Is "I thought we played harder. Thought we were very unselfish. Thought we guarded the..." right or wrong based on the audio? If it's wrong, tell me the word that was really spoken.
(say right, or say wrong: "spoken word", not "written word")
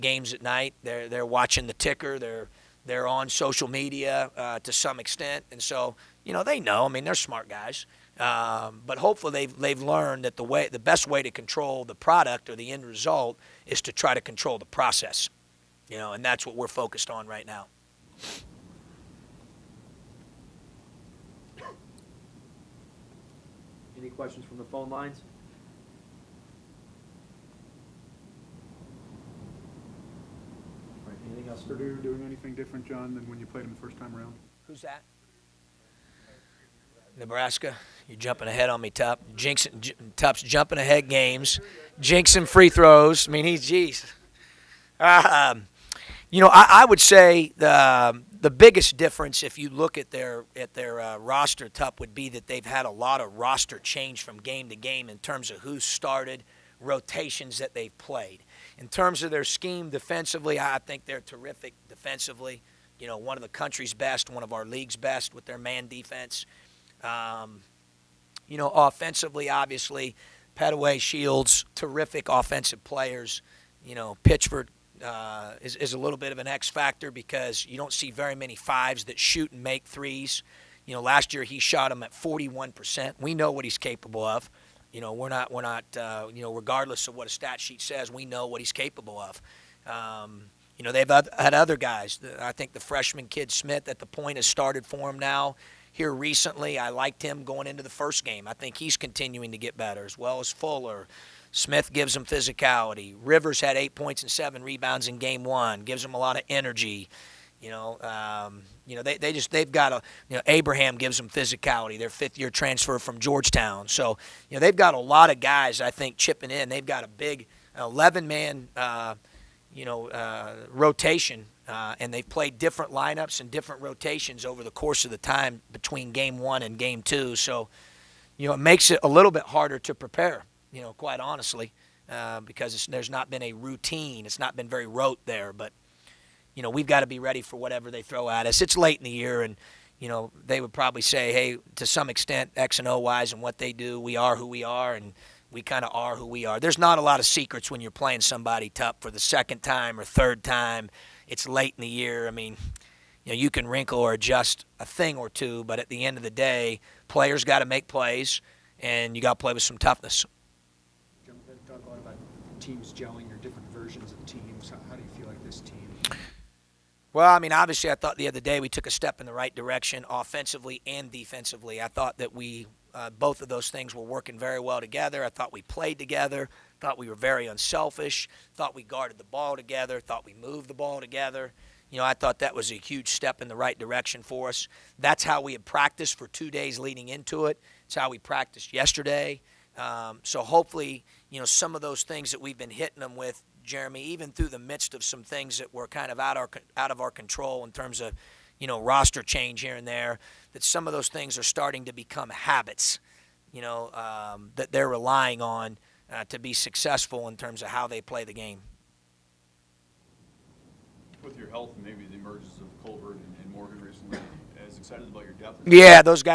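wrong: "together", not "harder".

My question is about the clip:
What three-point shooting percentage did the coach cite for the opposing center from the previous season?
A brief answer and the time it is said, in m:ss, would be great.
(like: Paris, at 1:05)
41%, at 1:22.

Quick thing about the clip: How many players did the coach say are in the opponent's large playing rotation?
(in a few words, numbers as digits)
11.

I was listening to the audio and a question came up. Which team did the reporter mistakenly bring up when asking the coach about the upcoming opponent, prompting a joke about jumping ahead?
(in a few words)
Nebraska.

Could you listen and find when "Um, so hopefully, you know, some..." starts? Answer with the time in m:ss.
3:09.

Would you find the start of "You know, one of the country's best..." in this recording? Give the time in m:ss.
1:02.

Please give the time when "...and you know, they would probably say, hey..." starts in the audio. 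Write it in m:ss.
2:19.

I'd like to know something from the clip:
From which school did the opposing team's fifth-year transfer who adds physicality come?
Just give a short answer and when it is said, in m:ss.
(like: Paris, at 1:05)
Georgetown, at 1:53.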